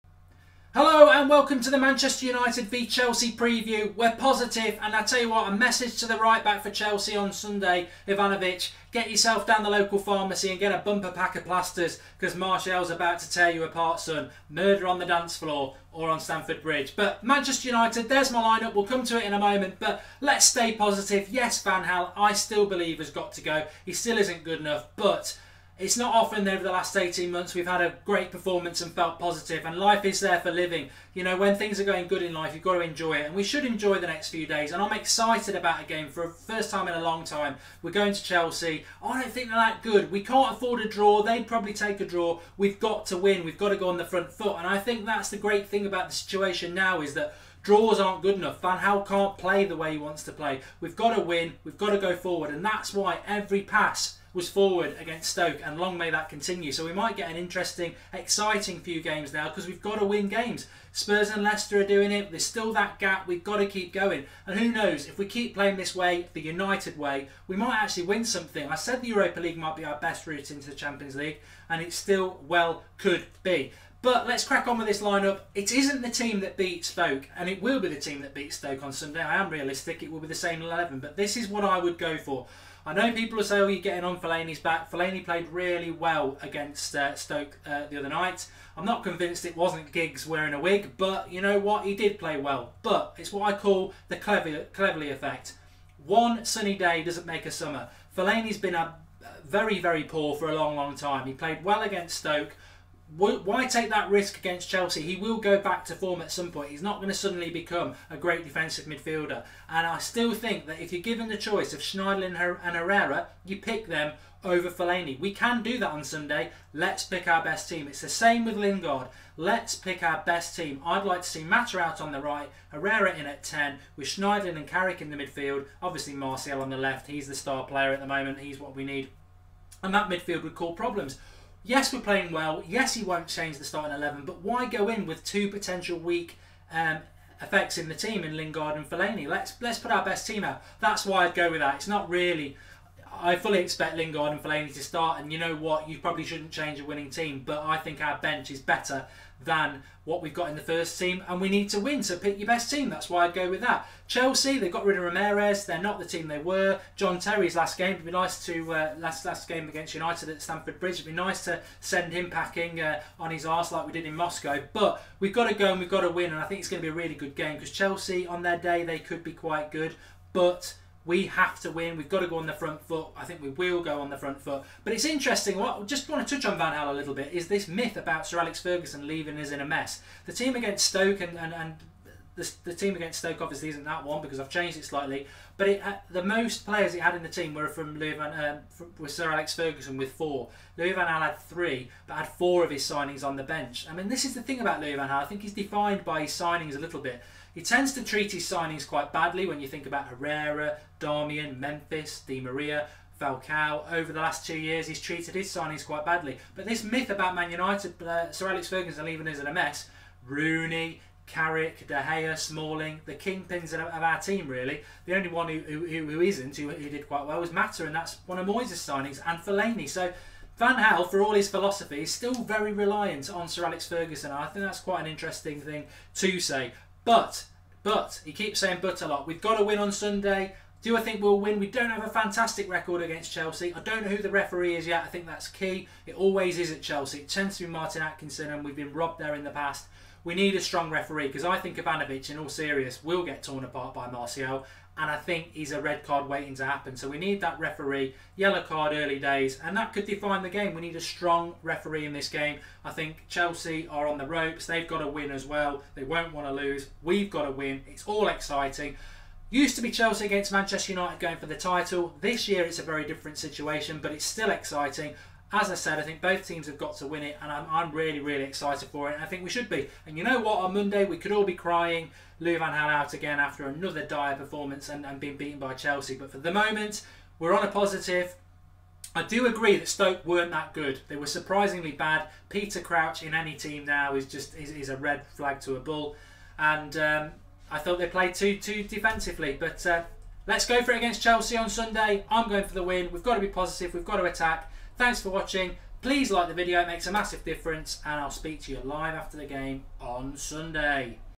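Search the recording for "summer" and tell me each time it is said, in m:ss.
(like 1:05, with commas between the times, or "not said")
1:37.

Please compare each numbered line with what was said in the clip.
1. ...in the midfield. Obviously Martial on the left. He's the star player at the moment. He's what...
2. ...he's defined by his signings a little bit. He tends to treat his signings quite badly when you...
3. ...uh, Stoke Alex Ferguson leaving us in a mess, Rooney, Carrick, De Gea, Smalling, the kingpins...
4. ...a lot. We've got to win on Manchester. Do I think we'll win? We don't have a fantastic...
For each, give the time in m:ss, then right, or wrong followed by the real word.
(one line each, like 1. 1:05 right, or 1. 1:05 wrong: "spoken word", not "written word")
1. 2:05 right
2. 3:15 right
3. 3:28 wrong: "Sir", not "Stoke"
4. 3:49 wrong: "Sunday", not "Manchester".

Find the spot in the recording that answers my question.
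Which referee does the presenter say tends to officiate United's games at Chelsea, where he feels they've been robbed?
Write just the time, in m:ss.
3:57.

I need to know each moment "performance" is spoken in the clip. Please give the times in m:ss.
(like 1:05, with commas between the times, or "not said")
0:28, 4:34.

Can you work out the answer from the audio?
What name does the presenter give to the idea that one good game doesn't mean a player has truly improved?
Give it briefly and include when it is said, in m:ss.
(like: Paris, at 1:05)
Cleverley effect, at 1:34.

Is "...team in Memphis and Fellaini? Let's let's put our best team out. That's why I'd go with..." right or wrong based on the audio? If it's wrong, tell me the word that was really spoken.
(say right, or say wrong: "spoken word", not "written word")
wrong: "Lingard", not "Memphis".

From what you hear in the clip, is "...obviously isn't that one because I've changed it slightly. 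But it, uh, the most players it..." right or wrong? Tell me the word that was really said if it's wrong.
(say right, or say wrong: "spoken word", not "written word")
right.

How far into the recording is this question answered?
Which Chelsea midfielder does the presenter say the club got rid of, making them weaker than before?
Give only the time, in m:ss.
2:35.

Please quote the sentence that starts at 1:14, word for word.
But let's crack on with this lineup.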